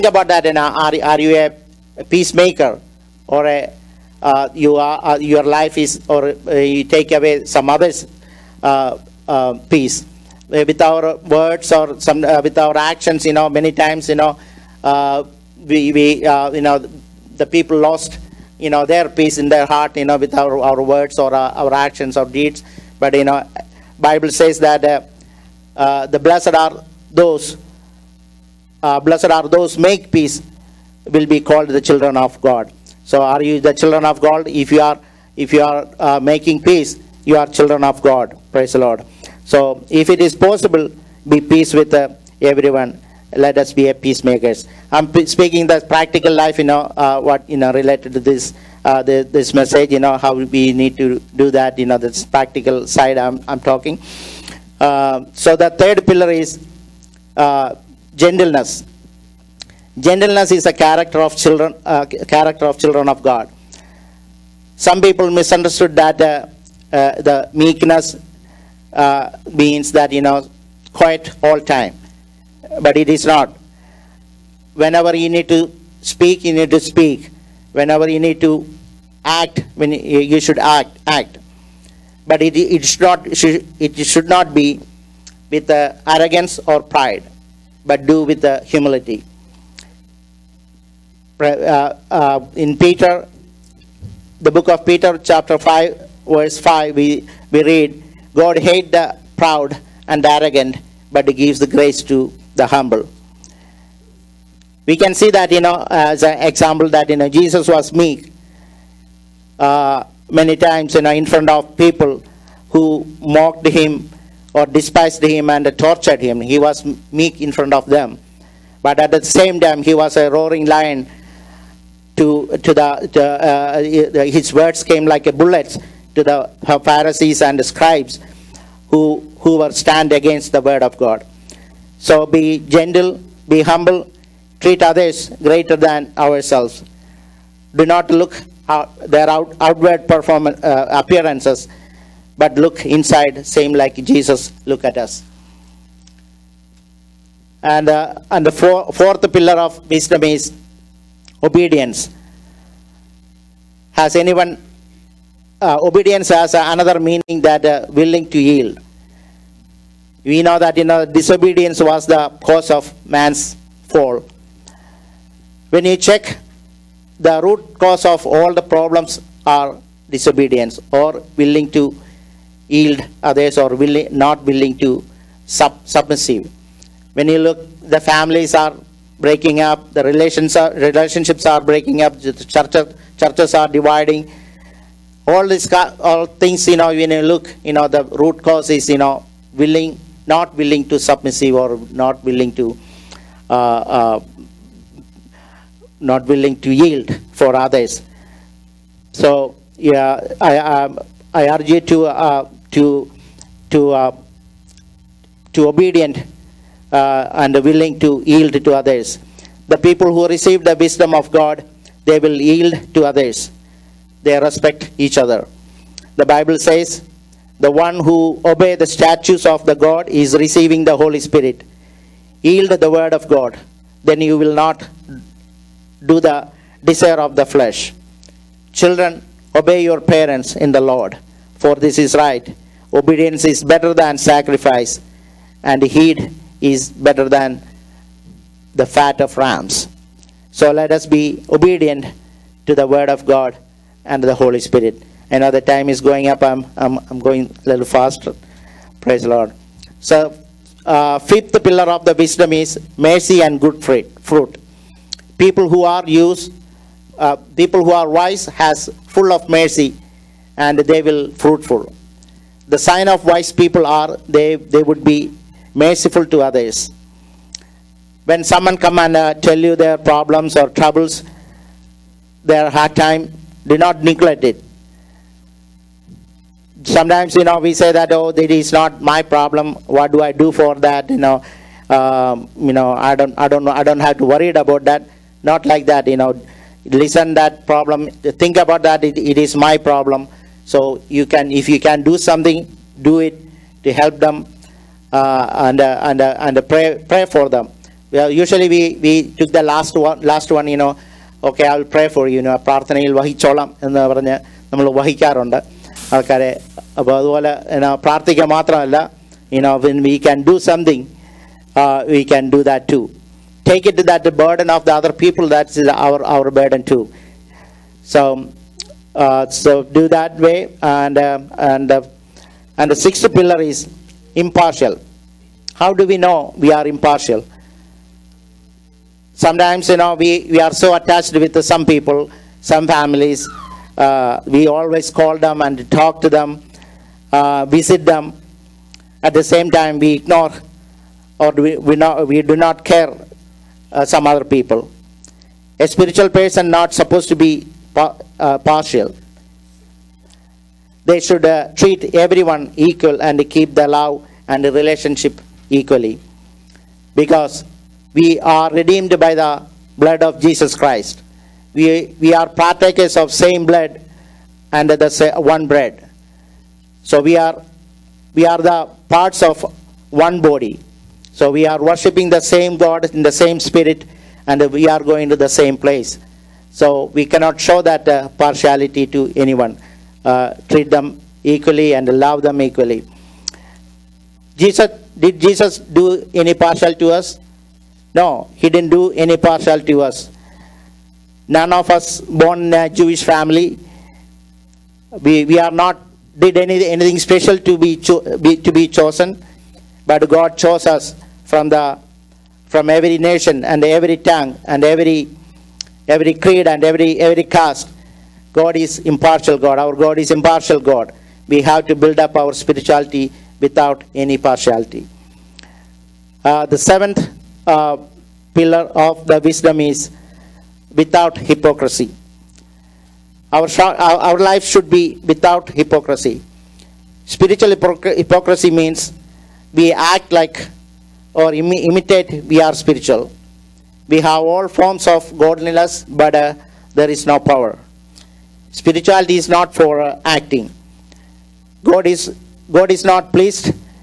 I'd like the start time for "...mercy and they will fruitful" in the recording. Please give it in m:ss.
4:19.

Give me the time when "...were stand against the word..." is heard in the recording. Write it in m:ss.
2:09.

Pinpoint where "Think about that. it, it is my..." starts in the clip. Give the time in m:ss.
4:48.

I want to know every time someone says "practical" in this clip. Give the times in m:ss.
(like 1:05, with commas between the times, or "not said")
0:45, 0:52.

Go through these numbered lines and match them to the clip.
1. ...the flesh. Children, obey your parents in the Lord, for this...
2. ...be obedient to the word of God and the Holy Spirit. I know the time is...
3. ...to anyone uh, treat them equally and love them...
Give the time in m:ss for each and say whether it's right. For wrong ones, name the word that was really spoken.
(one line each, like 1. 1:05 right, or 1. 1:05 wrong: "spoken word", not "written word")
1. 3:47 right
2. 4:01 right
3. 6:19 right.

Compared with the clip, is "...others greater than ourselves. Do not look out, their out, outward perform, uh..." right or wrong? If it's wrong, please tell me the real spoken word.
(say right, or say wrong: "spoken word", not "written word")
right.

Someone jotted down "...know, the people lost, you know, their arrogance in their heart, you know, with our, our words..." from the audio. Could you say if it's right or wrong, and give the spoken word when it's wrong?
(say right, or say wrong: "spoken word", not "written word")
wrong: "peace", not "arrogance".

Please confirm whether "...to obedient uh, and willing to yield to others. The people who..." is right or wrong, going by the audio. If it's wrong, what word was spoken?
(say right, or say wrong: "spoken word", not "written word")
right.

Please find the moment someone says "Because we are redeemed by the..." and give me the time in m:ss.
5:57.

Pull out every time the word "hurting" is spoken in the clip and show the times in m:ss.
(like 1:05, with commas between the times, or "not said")
not said.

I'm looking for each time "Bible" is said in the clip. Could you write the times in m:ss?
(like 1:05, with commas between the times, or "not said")
0:23, 3:36.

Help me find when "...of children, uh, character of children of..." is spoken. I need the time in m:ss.
1:01.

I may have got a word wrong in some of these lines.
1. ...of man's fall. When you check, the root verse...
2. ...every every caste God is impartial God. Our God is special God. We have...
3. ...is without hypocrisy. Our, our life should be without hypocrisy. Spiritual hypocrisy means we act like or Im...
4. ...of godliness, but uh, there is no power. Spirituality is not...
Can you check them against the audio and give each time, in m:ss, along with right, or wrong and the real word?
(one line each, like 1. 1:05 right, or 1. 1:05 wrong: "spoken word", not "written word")
1. 2:42 wrong: "cause", not "verse"
2. 6:46 wrong: "impartial", not "special"
3. 6:59 right
4. 7:15 right.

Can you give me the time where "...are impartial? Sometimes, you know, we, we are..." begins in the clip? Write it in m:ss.
5:26.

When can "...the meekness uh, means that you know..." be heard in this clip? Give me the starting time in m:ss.
1:07.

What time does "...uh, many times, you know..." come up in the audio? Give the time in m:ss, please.
1:49.